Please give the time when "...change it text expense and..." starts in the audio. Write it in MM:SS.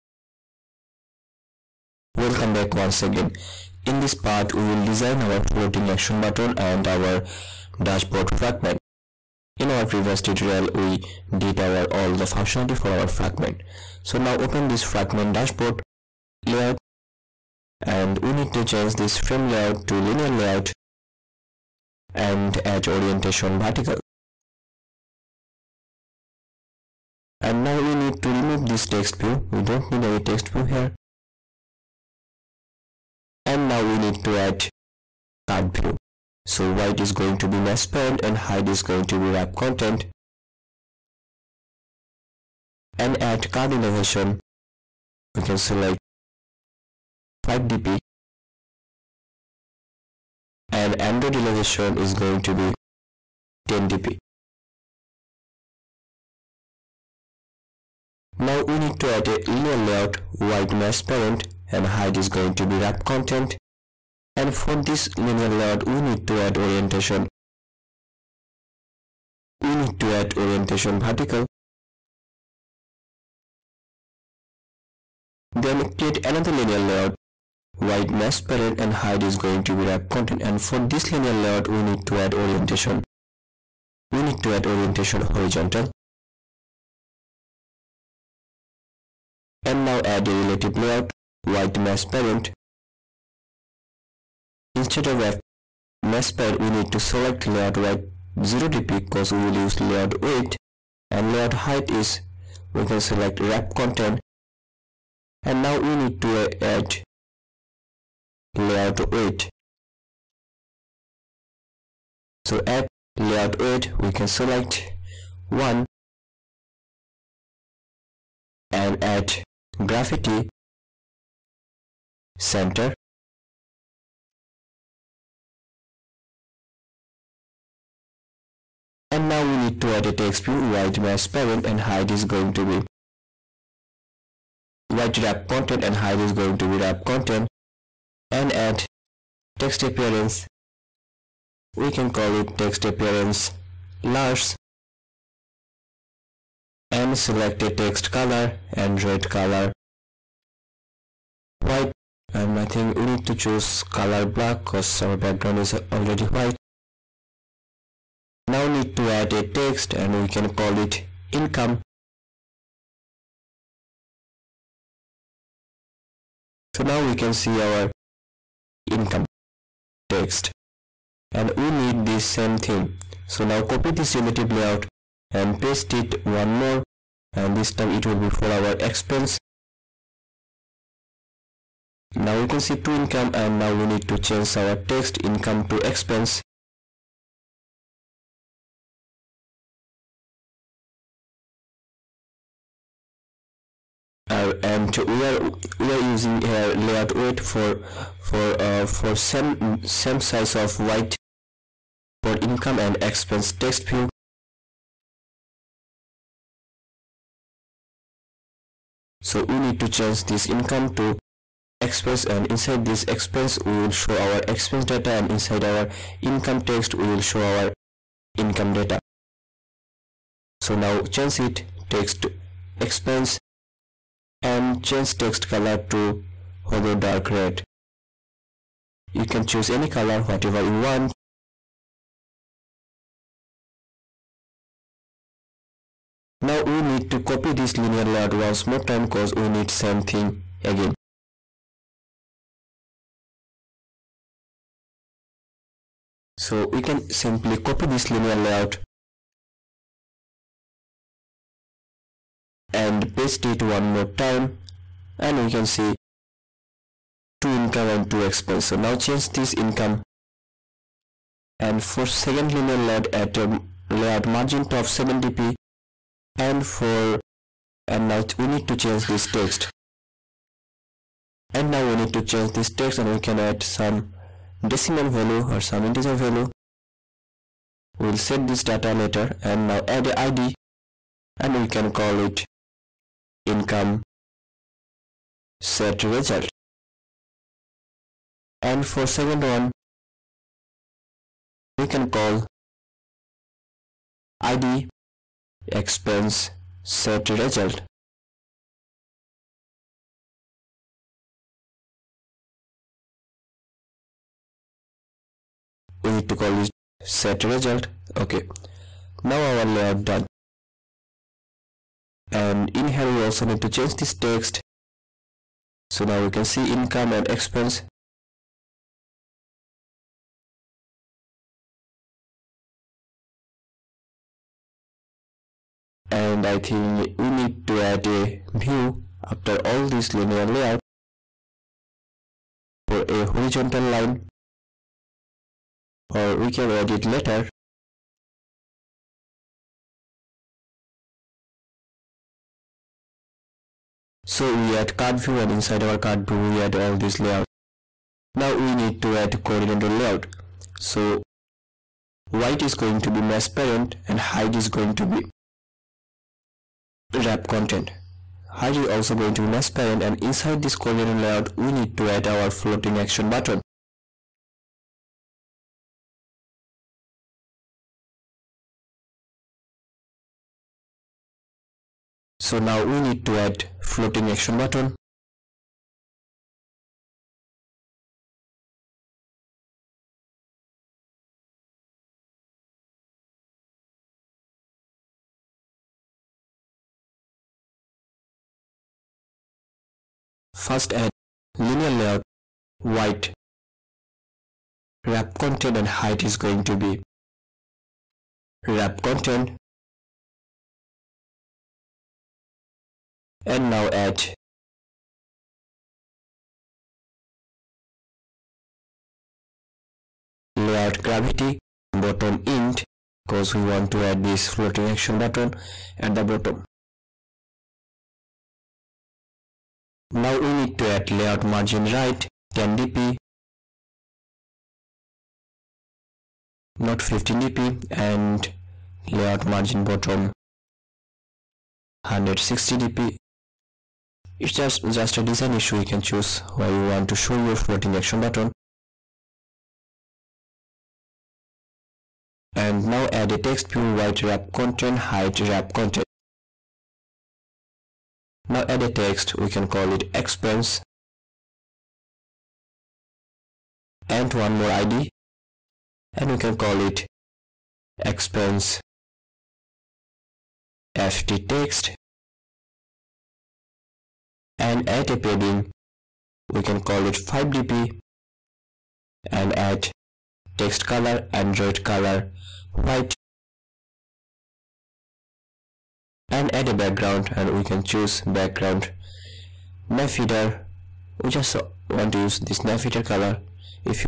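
03:41.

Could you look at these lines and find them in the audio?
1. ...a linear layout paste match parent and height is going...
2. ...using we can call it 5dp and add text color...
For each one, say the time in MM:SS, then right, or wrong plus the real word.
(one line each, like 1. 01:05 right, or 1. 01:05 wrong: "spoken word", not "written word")
1. 00:59 wrong: "white", not "paste"
2. 07:45 wrong: "padding", not "using".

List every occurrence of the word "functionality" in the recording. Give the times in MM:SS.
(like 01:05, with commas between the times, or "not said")
00:12.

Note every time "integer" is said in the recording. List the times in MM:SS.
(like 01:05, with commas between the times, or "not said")
04:35.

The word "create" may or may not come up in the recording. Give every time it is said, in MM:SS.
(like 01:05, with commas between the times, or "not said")
01:15.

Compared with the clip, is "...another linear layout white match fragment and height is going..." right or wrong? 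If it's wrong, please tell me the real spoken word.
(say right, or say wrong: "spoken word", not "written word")
wrong: "parent", not "fragment".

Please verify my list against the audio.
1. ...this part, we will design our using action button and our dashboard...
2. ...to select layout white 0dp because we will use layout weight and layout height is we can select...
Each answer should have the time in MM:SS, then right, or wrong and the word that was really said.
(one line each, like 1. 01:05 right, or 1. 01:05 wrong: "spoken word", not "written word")
1. 00:03 wrong: "floating", not "using"
2. 01:36 right.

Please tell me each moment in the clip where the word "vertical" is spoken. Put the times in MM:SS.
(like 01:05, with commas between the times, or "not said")
00:23, 01:10.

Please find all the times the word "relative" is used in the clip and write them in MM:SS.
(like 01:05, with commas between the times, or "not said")
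01:30, 02:54.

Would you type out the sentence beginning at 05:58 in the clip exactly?
Height is also going to be match parent and inside this coordinator layout we need to add our floating action button.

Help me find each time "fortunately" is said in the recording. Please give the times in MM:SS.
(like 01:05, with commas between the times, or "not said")
not said.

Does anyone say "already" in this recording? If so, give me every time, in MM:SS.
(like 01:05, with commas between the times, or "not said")
02:35.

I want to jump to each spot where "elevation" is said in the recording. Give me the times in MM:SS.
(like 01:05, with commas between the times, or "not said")
00:43, 00:51.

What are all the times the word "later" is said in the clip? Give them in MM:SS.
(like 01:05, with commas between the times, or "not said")
04:38, 05:37.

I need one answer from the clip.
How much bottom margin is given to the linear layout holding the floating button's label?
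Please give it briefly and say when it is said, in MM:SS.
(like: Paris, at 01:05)
160 dp, at 07:12.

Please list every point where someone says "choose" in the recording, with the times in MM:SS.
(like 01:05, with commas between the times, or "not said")
02:33, 03:49, 07:16, 07:57.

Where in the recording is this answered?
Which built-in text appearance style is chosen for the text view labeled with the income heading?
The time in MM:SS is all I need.
02:22.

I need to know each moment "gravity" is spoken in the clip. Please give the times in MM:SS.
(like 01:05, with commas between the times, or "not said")
01:59, 06:51.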